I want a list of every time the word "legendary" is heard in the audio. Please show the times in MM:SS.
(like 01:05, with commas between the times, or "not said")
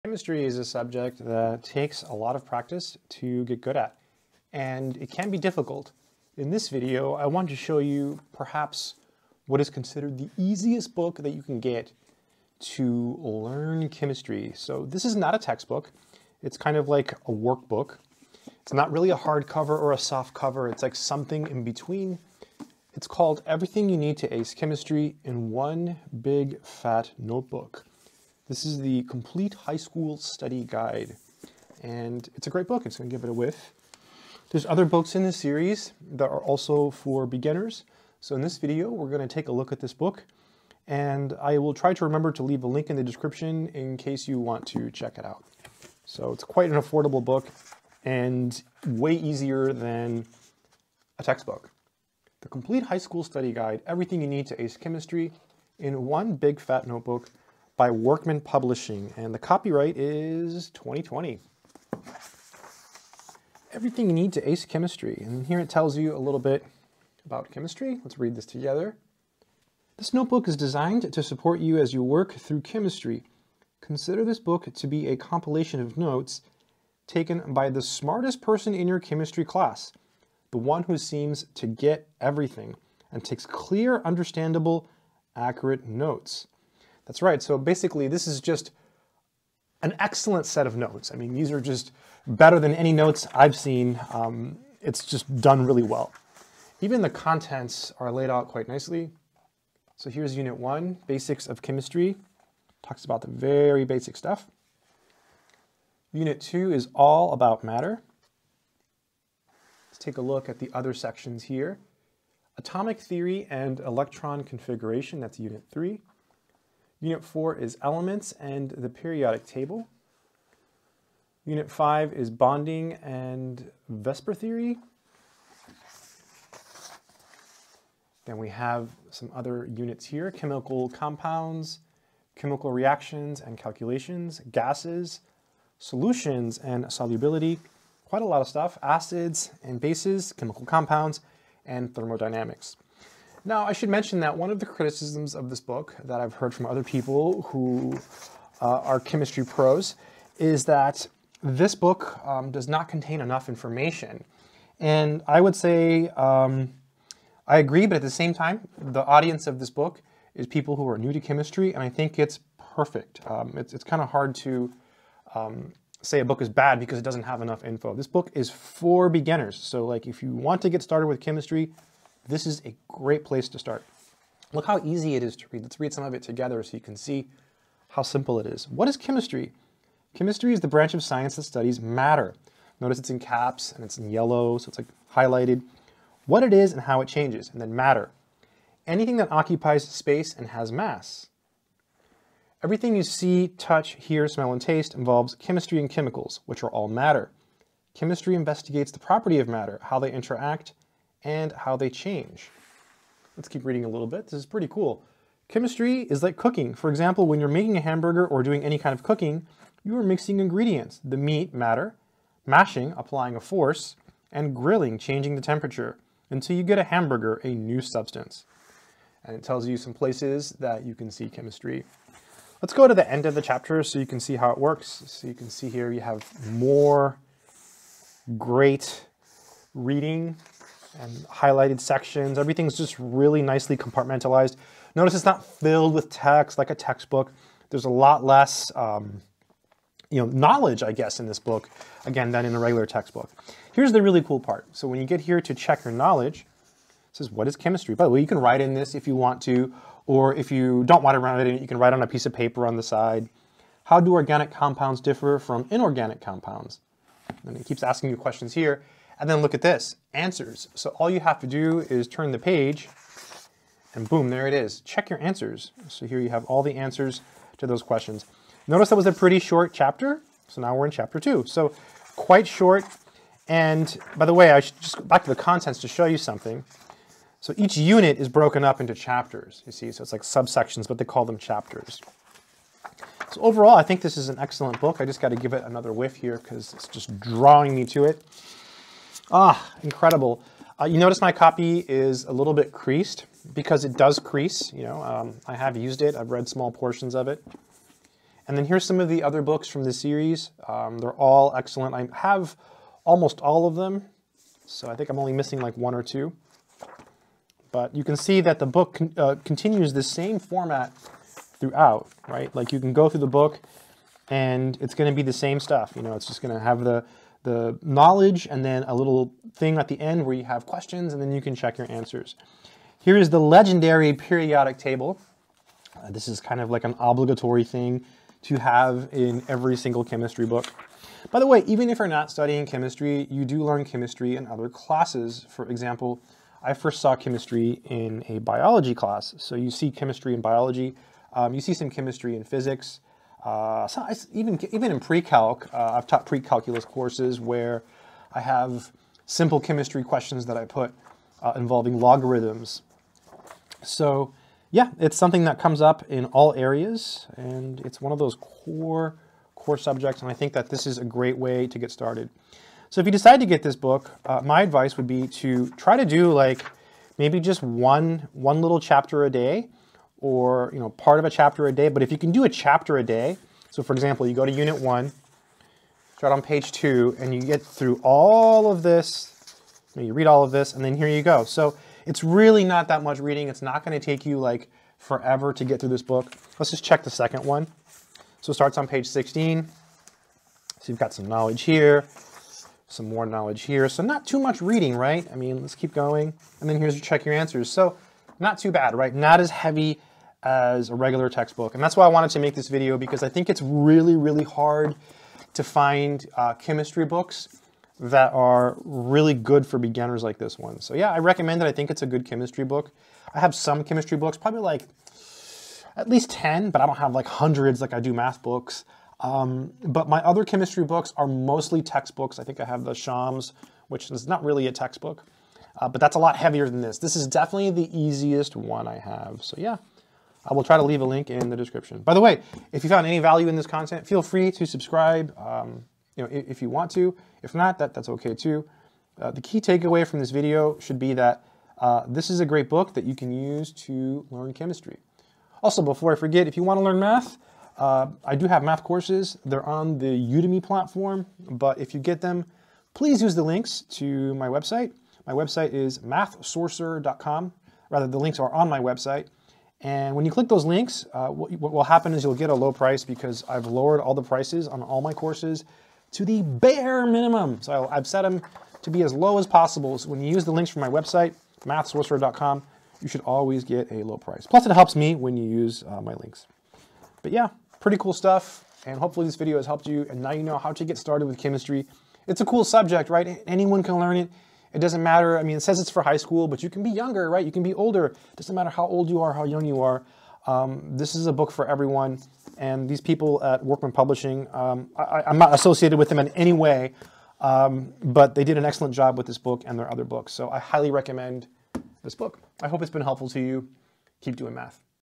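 05:23.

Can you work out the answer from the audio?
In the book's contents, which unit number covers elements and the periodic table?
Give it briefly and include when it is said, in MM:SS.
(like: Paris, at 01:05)
4, at 01:57.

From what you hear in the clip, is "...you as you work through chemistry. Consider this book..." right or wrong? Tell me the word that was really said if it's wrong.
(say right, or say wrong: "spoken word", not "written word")
right.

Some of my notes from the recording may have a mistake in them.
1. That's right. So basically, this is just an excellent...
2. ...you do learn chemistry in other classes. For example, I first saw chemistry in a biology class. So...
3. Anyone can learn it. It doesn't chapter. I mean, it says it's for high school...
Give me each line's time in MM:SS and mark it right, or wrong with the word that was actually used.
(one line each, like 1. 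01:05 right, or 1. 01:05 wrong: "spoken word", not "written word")
1. 01:27 right
2. 05:33 right
3. 08:03 wrong: "matter", not "chapter".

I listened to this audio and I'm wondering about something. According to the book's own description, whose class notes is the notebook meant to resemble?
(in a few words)
The smartest person in your chemistry class.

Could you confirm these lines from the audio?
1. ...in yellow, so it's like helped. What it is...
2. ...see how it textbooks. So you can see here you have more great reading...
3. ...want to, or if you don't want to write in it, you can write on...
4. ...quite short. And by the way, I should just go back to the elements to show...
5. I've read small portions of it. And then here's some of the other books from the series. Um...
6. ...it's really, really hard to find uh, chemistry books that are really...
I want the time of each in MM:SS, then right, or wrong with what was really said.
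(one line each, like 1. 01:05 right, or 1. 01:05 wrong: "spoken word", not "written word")
1. 03:03 wrong: "highlighted", not "helped"
2. 03:44 wrong: "works", not "textbooks"
3. 04:09 right
4. 04:32 wrong: "contents", not "elements"
5. 04:56 right
6. 06:43 right.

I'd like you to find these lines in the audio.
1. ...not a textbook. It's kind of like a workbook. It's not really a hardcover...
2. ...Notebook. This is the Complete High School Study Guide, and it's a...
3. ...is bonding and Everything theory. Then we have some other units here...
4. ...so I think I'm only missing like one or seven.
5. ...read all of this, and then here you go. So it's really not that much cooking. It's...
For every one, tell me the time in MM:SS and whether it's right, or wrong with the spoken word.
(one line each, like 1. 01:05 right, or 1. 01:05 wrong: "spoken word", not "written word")
1. 00:15 right
2. 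00:27 right
3. 02:02 wrong: "VSEPR", not "Everything"
4. 05:04 wrong: "two", not "seven"
5. 06:20 wrong: "reading", not "cooking".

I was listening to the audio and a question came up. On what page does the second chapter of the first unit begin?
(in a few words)
16.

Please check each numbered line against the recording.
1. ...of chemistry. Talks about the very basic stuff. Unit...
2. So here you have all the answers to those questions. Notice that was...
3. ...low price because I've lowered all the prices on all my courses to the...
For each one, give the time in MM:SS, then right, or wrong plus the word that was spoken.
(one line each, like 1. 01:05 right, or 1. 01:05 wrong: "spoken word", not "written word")
1. 01:41 right
2. 04:25 right
3. 07:42 right.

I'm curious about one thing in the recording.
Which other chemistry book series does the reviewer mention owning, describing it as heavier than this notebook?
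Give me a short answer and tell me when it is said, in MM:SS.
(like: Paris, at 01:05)
Schaum's, at 07:02.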